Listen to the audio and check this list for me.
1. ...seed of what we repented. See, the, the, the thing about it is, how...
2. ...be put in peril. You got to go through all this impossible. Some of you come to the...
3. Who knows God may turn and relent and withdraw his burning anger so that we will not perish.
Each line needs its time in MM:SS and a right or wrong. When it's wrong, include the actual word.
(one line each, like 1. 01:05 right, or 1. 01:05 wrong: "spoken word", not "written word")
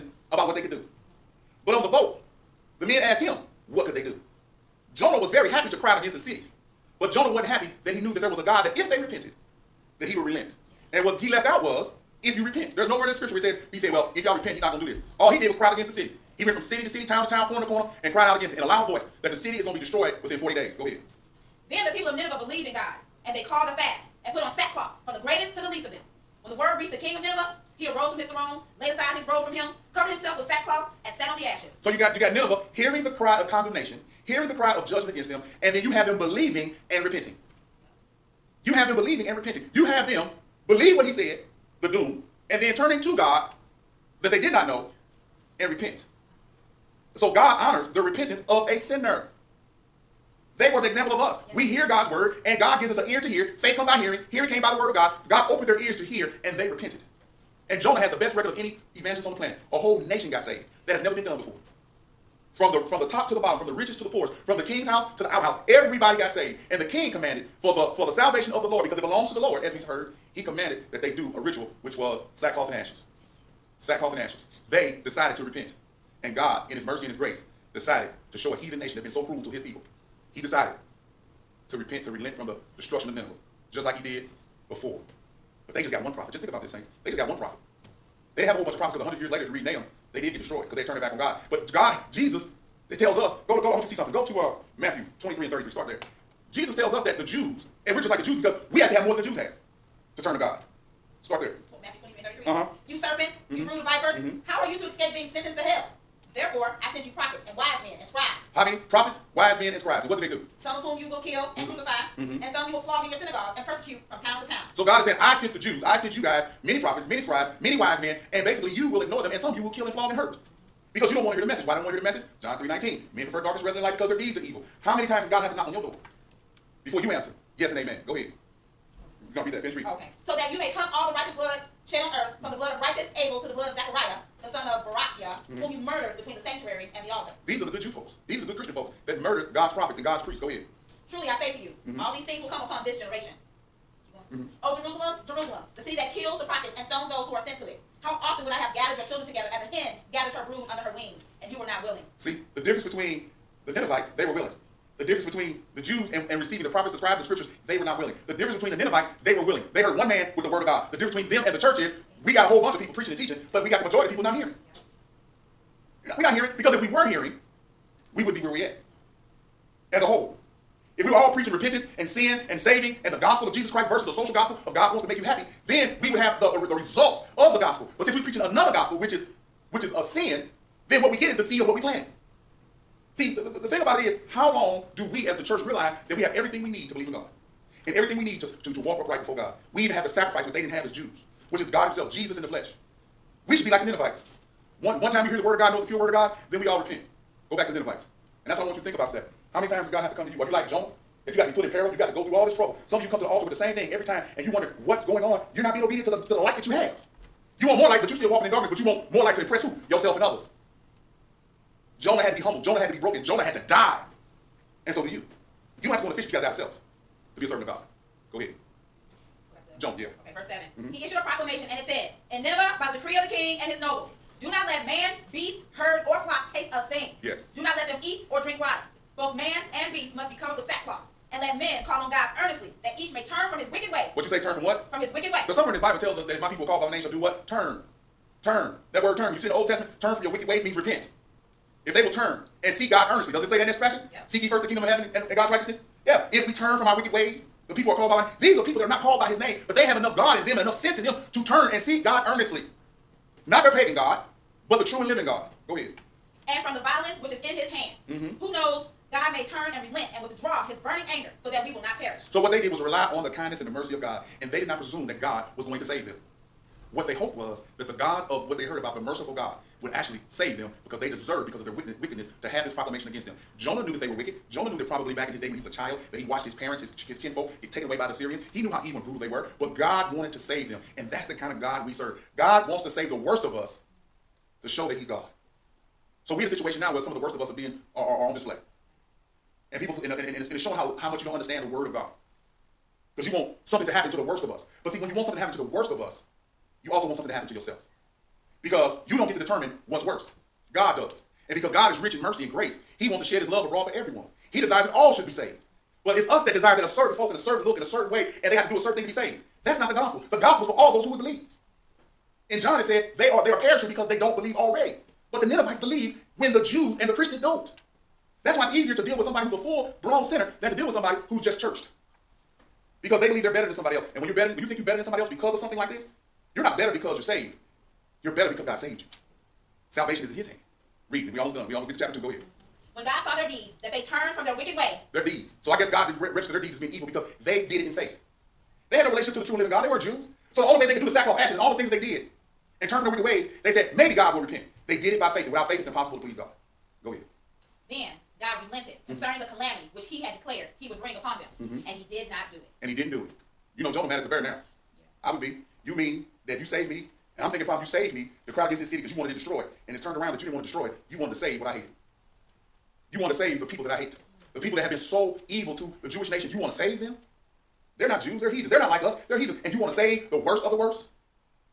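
1. 03:01 wrong: "planted", not "repented"
2. 03:21 wrong: "trouble", not "impossible"
3. 04:18 right.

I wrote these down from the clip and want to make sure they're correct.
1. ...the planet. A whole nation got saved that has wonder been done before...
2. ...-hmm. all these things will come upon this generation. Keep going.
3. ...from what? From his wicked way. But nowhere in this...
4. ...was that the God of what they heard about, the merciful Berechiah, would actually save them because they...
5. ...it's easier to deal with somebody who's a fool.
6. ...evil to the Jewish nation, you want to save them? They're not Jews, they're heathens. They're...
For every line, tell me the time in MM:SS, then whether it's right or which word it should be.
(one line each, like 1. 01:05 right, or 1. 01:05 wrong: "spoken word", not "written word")
1. 00:59 wrong: "never", not "wonder"
2. 02:21 right
3. 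03:54 wrong: "somewhere", not "nowhere"
4. 04:27 wrong: "God", not "Berechiah"
5. 05:18 right
6. 06:05 right.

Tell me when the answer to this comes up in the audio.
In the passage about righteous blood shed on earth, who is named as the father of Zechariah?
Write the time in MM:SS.
02:14.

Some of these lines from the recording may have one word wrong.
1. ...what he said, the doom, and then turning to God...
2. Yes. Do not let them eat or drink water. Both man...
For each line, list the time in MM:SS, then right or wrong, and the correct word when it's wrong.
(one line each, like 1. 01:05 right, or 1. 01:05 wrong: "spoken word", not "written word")
1. 00:40 right
2. 03:47 right.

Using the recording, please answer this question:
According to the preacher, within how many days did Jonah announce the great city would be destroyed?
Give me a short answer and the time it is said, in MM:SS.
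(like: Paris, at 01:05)
40, at 00:20.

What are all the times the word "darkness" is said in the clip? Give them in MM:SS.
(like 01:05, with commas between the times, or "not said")
02:03, 03:28.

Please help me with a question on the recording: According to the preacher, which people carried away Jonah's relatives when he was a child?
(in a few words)
the Syrians.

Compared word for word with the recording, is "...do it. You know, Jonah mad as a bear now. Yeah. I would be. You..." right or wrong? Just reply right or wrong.
right.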